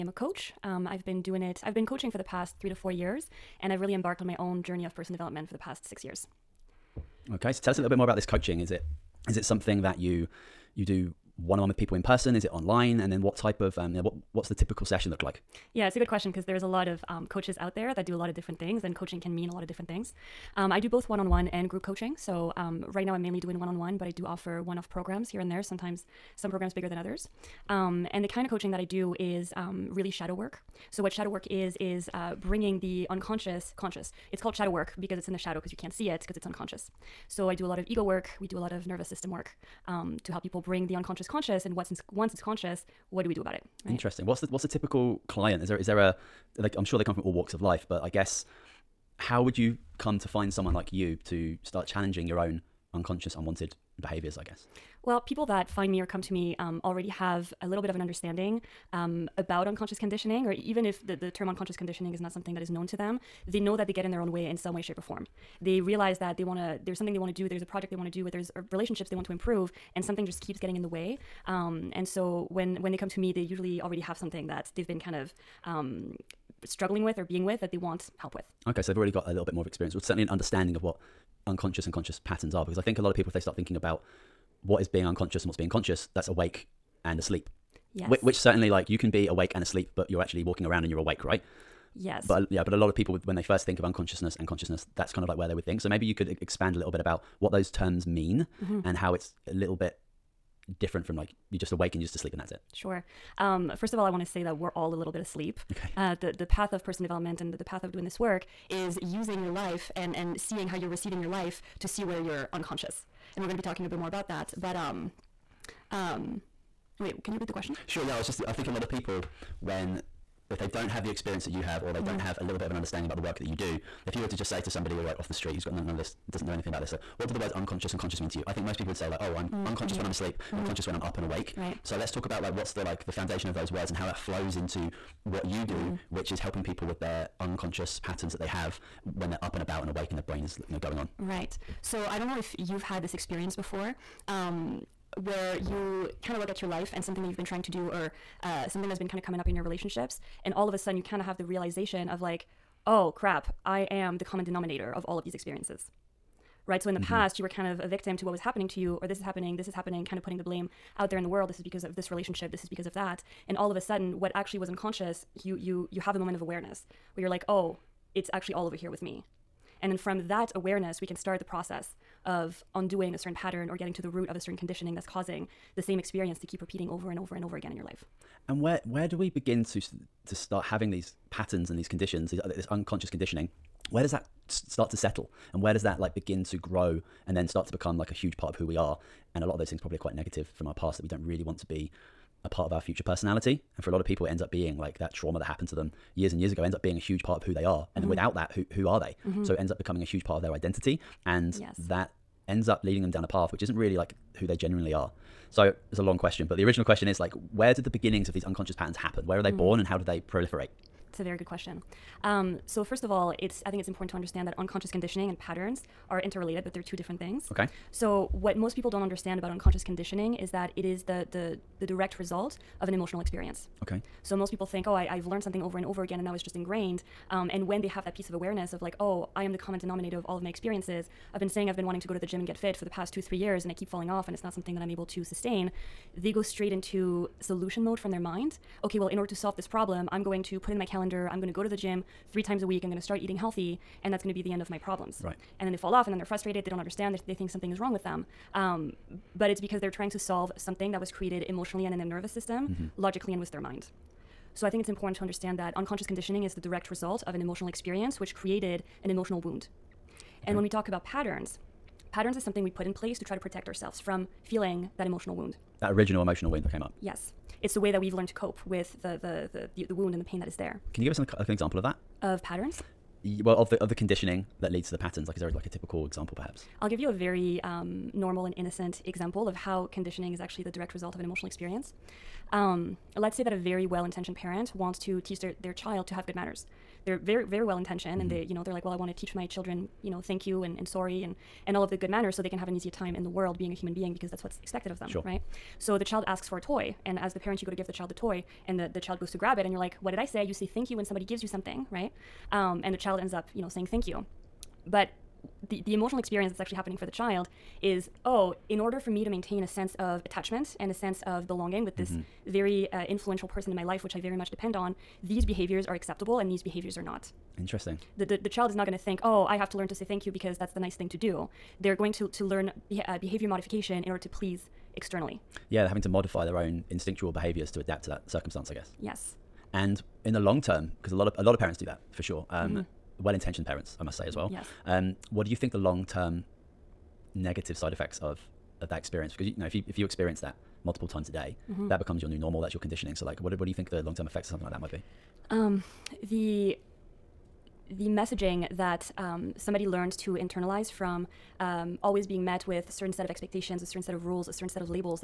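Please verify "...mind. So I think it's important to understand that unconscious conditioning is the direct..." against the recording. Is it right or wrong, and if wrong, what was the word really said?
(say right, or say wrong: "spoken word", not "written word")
right.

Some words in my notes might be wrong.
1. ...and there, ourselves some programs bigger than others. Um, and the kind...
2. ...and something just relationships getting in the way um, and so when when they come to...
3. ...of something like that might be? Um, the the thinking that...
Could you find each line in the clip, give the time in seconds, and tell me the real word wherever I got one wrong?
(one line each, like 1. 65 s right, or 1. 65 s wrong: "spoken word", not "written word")
1. 25 s wrong: "sometimes", not "ourselves"
2. 69 s wrong: "keeps", not "relationships"
3. 344 s wrong: "messaging", not "thinking".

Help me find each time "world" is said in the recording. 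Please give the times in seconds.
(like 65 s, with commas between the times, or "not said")
161 s, 293 s.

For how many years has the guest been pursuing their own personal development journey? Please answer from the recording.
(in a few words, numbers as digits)
6 years.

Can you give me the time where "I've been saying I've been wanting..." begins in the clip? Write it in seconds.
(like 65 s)
231 s.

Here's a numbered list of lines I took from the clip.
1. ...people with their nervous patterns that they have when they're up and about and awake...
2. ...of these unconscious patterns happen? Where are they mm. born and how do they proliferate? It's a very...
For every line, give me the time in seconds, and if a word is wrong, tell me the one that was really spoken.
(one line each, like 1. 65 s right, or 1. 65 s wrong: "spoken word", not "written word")
1. 136 s wrong: "unconscious", not "nervous"
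2. 208 s right.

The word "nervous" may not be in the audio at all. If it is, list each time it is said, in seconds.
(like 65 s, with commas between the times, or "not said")
38 s, 252 s.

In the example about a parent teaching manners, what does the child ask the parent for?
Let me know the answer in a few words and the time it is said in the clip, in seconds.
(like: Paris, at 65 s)
A toy, at 296 s.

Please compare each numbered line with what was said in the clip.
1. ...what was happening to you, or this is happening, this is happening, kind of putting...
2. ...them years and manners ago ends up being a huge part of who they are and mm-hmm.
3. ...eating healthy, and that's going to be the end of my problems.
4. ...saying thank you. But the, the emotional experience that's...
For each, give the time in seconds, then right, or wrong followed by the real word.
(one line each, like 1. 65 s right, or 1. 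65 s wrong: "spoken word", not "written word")
1. 158 s right
2. 195 s wrong: "years", not "manners"
3. 243 s right
4. 303 s right.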